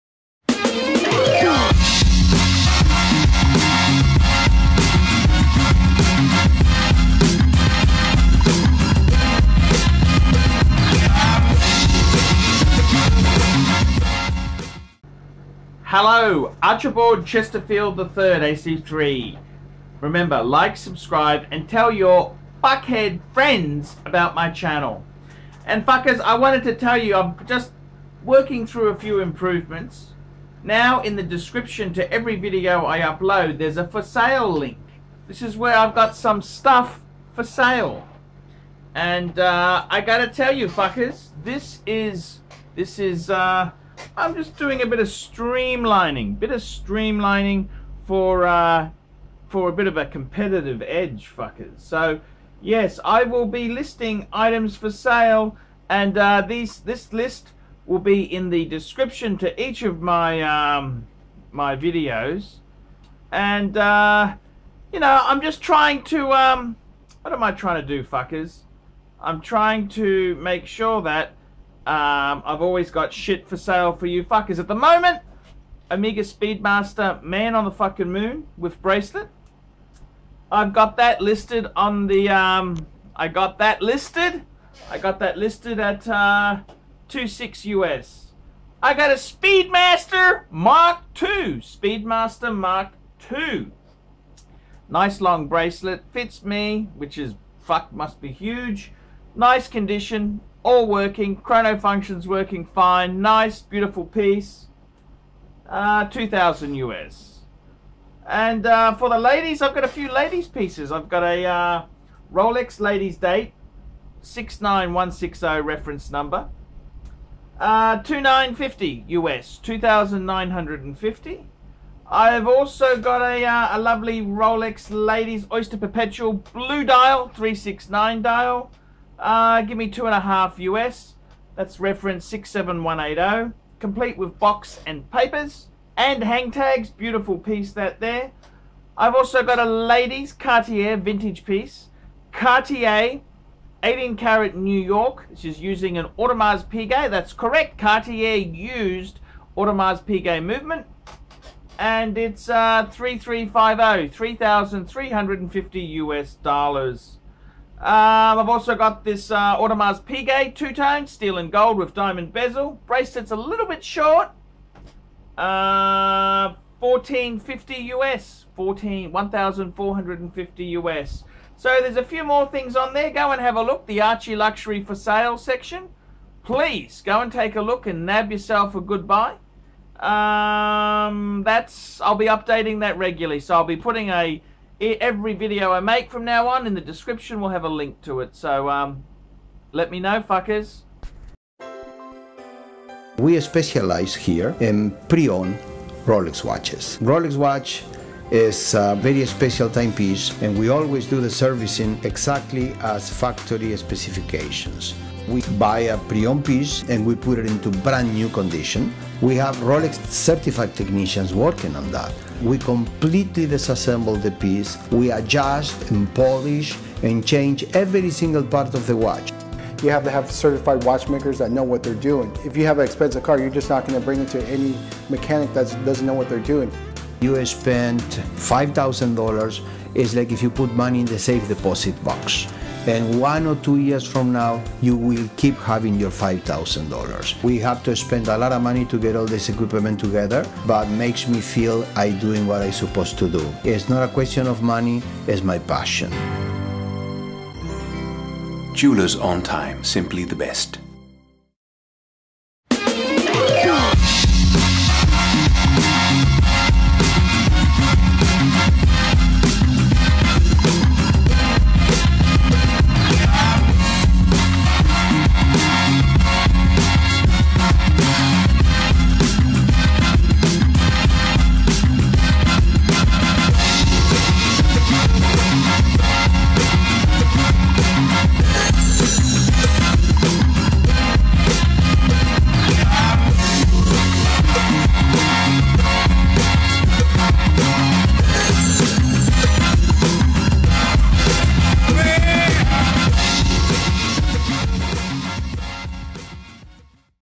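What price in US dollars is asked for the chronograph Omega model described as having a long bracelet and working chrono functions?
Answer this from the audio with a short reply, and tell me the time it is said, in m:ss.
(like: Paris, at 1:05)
2000, at 1:46.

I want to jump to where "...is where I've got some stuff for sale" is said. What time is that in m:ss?
0:35.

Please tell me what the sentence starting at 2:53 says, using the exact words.
The Archie Luxury for Sale section.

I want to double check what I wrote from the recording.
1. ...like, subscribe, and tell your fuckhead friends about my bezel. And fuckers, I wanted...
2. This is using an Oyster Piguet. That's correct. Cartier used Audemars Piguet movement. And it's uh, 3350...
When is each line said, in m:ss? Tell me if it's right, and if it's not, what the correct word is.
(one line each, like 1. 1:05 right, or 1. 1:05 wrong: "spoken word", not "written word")
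1. 0:20 wrong: "channel", not "bezel"
2. 2:25 wrong: "Audemars", not "Oyster".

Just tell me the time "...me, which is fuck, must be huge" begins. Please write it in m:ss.
1:36.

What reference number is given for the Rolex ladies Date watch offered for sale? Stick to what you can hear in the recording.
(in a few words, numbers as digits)
69160.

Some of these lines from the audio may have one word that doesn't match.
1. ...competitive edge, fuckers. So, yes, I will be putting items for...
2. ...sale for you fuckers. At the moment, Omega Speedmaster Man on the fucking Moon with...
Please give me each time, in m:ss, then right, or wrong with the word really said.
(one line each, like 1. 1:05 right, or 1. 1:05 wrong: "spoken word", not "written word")
1. 0:50 wrong: "listing", not "putting"
2. 1:13 right.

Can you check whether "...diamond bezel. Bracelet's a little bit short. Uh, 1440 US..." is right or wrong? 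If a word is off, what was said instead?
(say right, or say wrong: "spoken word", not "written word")
wrong: "1450", not "1440".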